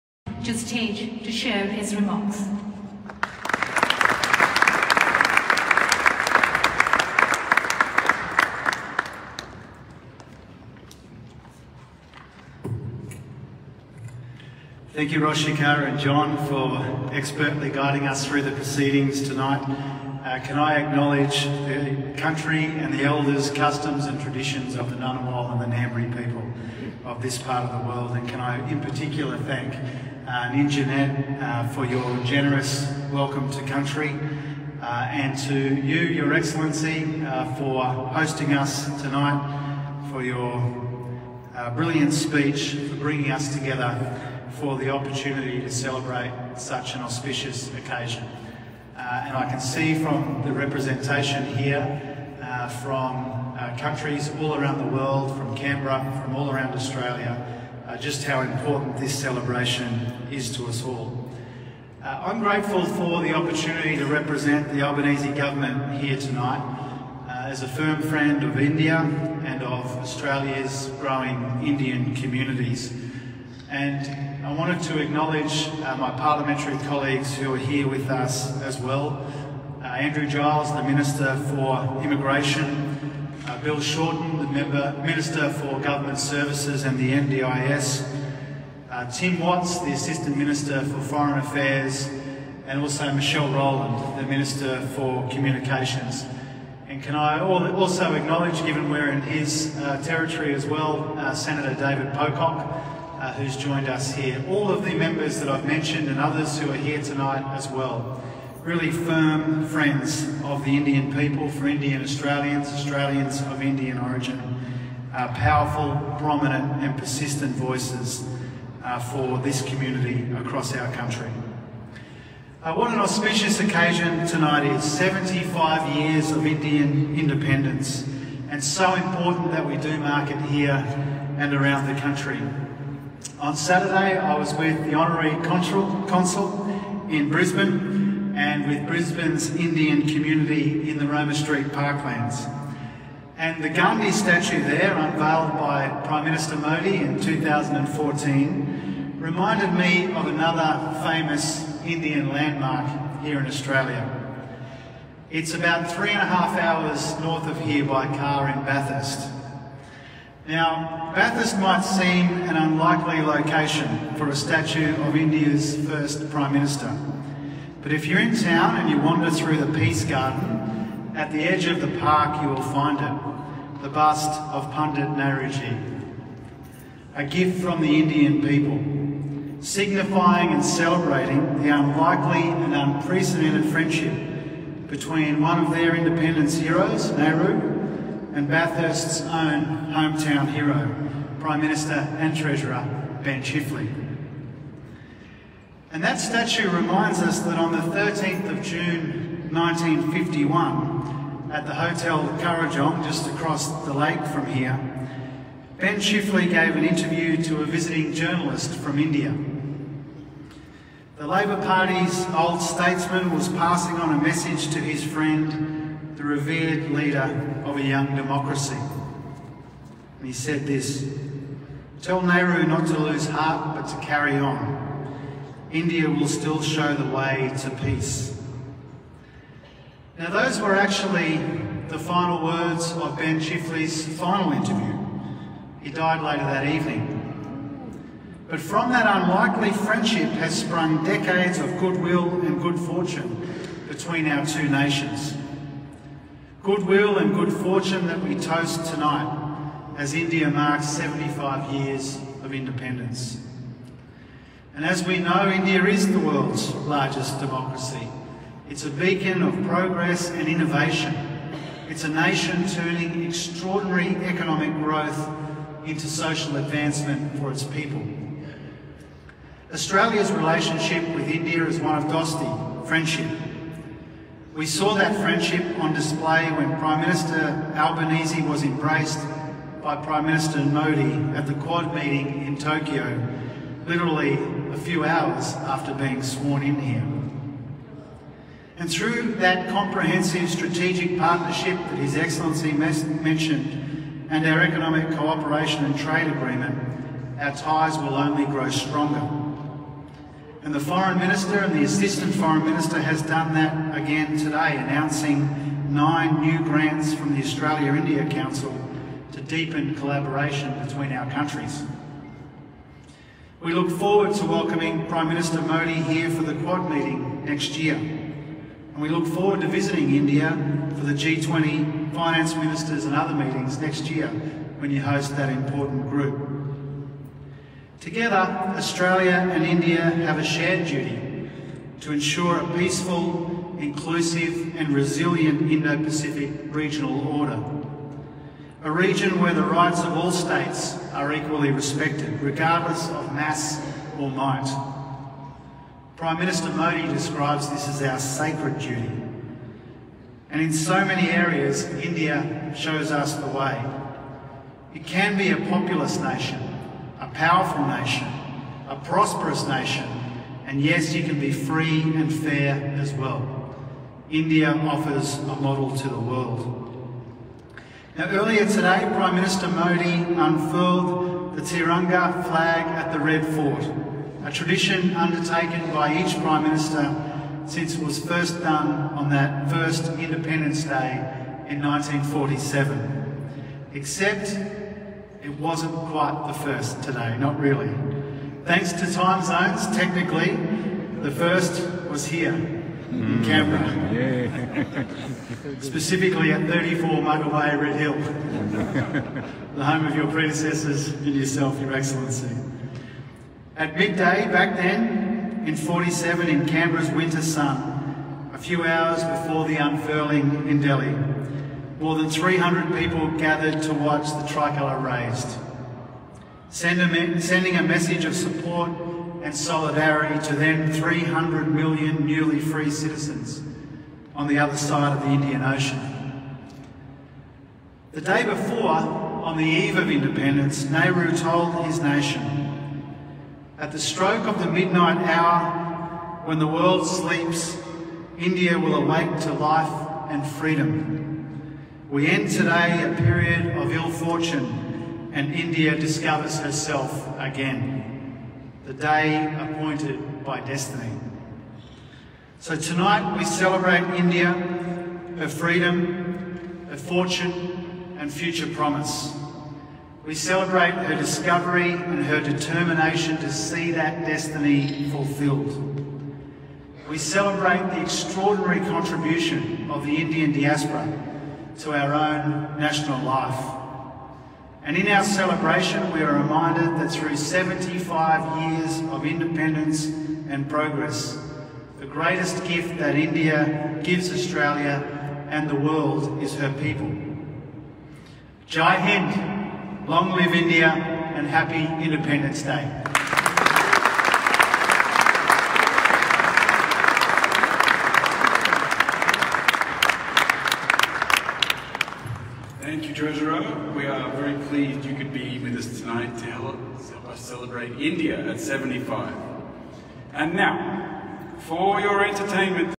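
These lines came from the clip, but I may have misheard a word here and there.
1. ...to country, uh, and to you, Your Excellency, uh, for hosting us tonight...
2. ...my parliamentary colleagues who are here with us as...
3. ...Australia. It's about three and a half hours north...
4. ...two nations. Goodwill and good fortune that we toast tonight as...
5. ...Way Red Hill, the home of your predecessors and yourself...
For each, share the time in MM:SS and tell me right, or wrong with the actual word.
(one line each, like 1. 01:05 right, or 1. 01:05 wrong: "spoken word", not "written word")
1. 00:33 right
2. 01:15 right
3. 02:33 right
4. 04:04 right
5. 06:37 right.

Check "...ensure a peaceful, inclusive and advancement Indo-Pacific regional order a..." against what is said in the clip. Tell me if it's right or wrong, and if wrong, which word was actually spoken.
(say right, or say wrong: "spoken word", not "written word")
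wrong: "resilient", not "advancement".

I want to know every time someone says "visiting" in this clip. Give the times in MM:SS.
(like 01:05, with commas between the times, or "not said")
03:27, 05:19.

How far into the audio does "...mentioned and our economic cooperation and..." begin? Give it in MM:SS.
04:52.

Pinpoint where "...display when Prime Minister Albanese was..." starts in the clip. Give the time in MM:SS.
04:35.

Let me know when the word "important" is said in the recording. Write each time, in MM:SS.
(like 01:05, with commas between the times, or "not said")
00:58, 02:08, 05:25.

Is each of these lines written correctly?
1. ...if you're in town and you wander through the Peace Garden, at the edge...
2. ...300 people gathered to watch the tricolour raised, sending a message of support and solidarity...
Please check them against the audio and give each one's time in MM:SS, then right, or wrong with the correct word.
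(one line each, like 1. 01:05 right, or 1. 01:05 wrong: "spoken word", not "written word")
1. 02:47 right
2. 06:52 right.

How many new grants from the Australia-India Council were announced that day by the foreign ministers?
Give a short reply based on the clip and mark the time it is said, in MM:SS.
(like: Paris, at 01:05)
9, at 05:05.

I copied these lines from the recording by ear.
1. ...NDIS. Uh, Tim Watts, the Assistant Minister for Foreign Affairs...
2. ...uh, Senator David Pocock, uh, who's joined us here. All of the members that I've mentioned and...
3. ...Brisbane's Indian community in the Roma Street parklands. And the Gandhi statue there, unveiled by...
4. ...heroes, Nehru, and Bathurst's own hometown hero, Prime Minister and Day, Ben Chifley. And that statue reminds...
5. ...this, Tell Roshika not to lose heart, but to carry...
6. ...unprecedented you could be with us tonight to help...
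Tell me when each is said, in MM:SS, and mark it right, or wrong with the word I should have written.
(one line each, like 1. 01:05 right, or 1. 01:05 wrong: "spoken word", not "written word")
1. 01:27 right
2. 01:41 right
3. 02:18 right
4. 03:06 wrong: "Treasurer", not "Day"
5. 03:40 wrong: "Nehru", not "Roshika"
6. 08:24 wrong: "pleased", not "unprecedented".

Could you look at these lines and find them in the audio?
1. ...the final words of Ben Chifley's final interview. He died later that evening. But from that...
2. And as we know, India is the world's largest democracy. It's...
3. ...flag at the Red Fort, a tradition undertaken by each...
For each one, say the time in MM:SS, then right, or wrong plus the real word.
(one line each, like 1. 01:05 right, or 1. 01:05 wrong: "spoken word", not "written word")
1. 03:51 right
2. 04:14 right
3. 06:12 right.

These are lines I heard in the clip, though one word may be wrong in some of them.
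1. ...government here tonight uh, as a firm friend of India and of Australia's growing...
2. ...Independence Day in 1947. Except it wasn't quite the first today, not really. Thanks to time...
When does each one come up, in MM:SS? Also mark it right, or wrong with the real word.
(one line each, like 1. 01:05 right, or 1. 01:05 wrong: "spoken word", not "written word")
1. 01:05 right
2. 06:20 right.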